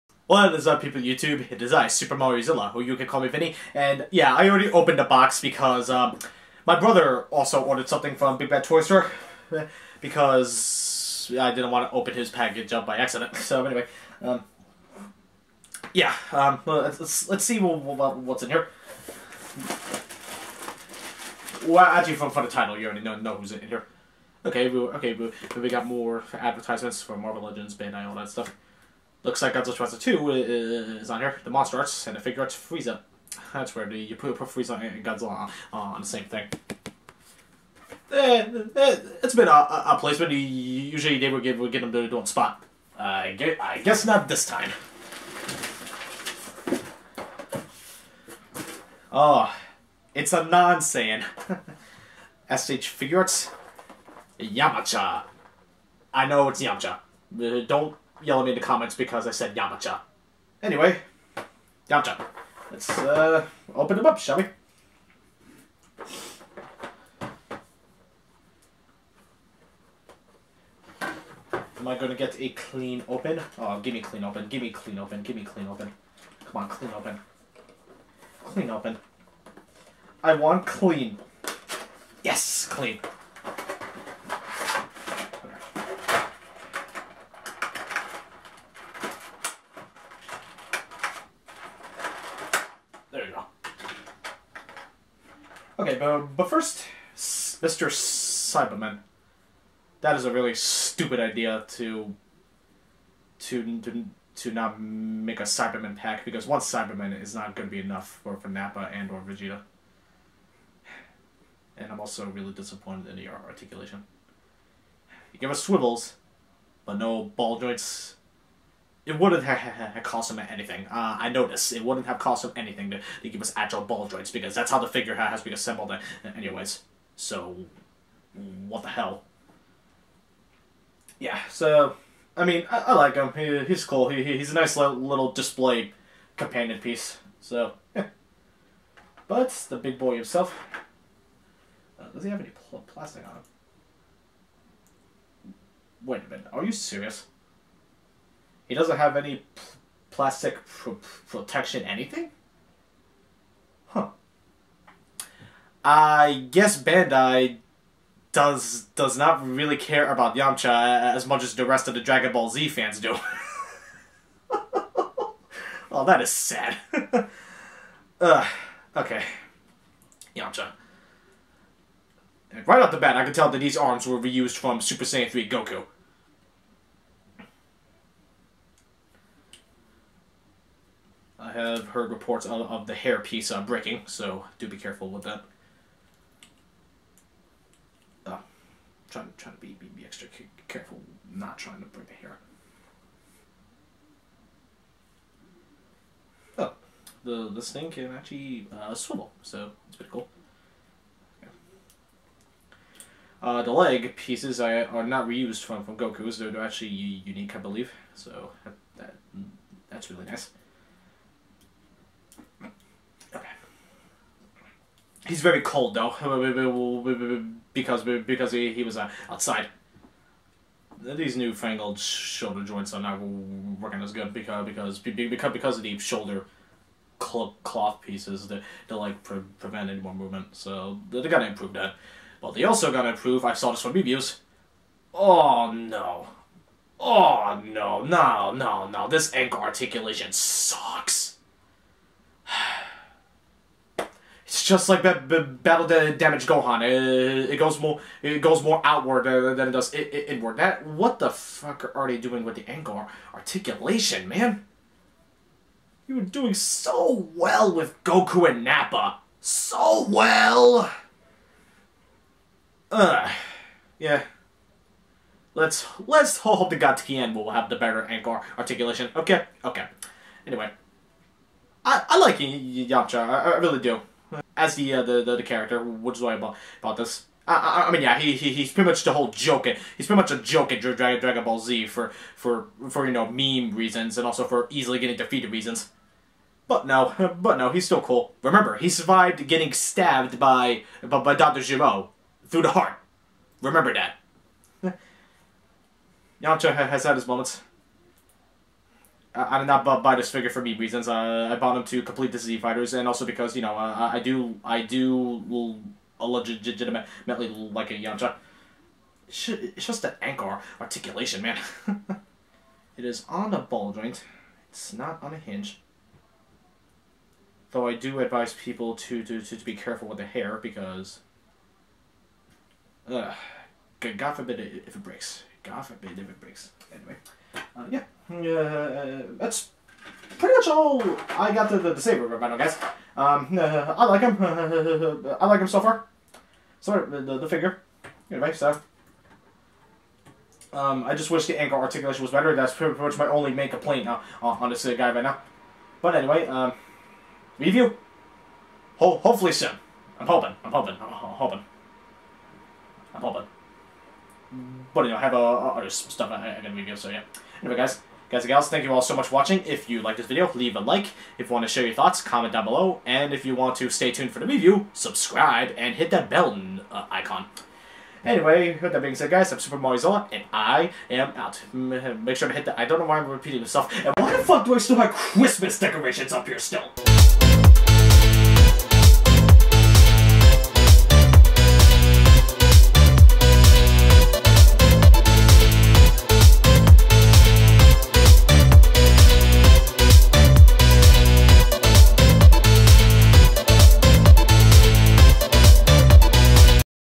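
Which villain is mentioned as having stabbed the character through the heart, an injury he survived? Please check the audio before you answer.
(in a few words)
Doctor Gero.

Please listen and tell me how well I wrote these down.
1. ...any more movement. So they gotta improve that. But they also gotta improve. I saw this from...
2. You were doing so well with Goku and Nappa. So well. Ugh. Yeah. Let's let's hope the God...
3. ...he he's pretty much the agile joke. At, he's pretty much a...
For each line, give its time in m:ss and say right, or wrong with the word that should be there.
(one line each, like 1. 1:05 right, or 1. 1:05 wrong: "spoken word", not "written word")
1. 3:49 right
2. 4:16 right
3. 4:38 wrong: "whole", not "agile".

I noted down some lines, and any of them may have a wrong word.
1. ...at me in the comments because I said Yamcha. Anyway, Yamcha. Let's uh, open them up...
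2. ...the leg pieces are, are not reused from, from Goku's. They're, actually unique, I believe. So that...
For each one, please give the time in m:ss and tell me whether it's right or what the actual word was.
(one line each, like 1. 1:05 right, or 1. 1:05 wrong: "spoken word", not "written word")
1. 0:58 right
2. 3:23 right.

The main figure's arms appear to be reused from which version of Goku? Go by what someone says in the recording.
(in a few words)
Super Saiyan 3 Goku.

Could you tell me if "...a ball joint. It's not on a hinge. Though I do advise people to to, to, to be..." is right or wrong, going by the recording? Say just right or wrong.
right.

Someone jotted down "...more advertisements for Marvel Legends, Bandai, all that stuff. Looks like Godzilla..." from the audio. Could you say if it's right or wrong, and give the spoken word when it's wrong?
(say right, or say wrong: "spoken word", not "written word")
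right.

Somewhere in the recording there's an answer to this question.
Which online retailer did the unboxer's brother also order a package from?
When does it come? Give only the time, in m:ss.
0:08.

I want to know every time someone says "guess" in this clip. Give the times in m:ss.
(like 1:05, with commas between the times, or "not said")
0:43, 2:36.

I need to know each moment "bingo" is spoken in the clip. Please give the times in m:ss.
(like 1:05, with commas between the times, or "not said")
not said.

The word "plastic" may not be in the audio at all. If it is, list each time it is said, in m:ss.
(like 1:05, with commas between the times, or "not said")
2:22, 2:30.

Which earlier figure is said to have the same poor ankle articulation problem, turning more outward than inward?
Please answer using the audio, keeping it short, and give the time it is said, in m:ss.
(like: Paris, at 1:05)
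battle damage Gohan, at 4:05.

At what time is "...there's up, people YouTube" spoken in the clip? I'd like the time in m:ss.
0:00.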